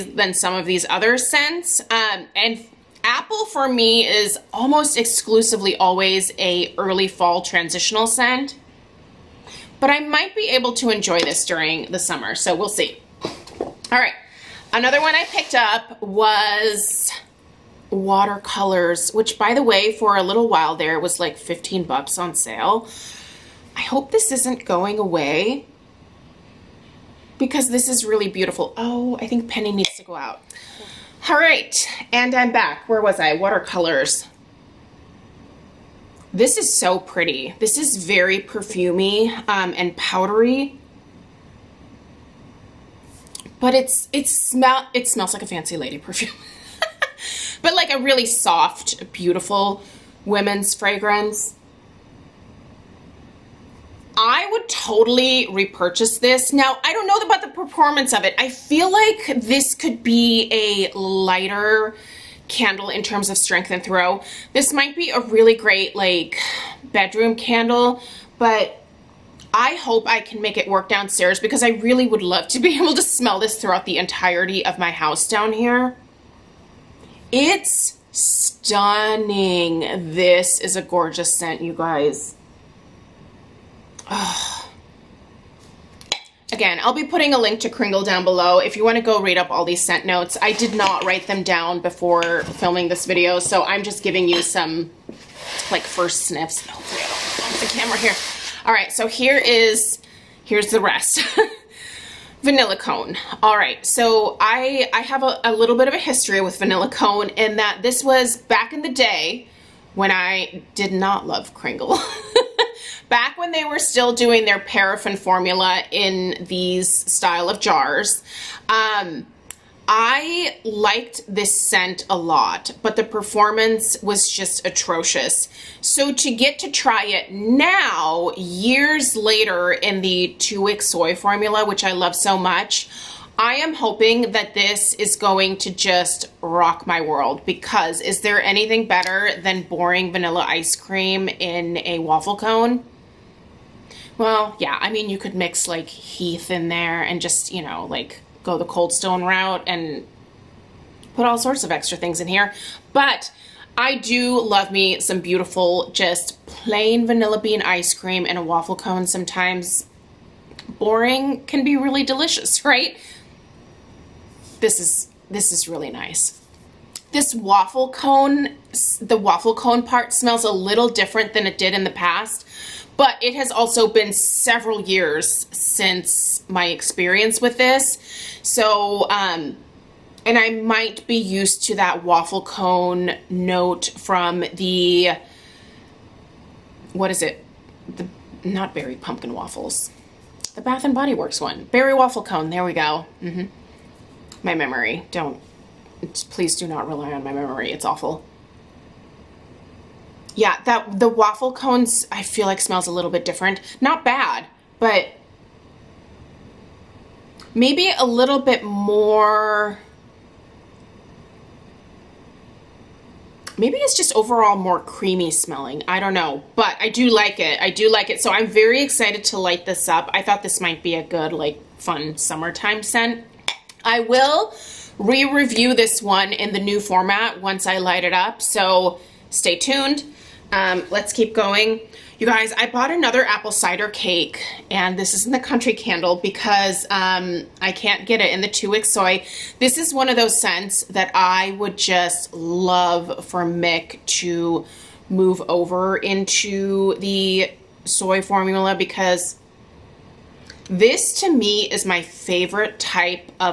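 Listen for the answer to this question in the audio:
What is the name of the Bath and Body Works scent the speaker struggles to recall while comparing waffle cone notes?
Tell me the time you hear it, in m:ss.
3:11.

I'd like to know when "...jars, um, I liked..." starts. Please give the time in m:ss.
1:57.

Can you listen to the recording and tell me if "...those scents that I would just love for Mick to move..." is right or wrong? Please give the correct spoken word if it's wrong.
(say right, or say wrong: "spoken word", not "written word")
right.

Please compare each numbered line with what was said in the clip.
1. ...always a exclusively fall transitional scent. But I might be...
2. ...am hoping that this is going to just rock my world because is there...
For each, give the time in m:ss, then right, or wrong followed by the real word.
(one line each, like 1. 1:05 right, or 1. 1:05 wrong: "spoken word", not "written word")
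1. 0:05 wrong: "early", not "exclusively"
2. 2:13 right.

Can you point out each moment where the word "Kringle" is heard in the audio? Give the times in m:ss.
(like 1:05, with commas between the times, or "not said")
1:27, 1:51.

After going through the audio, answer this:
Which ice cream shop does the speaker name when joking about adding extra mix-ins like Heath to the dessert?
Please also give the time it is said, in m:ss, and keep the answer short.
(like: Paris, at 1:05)
Cold Stone, at 2:28.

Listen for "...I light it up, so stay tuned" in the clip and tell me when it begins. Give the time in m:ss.
3:47.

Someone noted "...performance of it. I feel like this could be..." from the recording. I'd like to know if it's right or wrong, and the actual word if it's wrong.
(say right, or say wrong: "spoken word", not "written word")
right.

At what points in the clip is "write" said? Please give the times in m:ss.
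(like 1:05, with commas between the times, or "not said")
1:31.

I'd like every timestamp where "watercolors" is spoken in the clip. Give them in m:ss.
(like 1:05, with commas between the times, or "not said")
0:17, 0:33.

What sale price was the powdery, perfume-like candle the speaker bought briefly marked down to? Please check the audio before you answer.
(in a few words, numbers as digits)
$15.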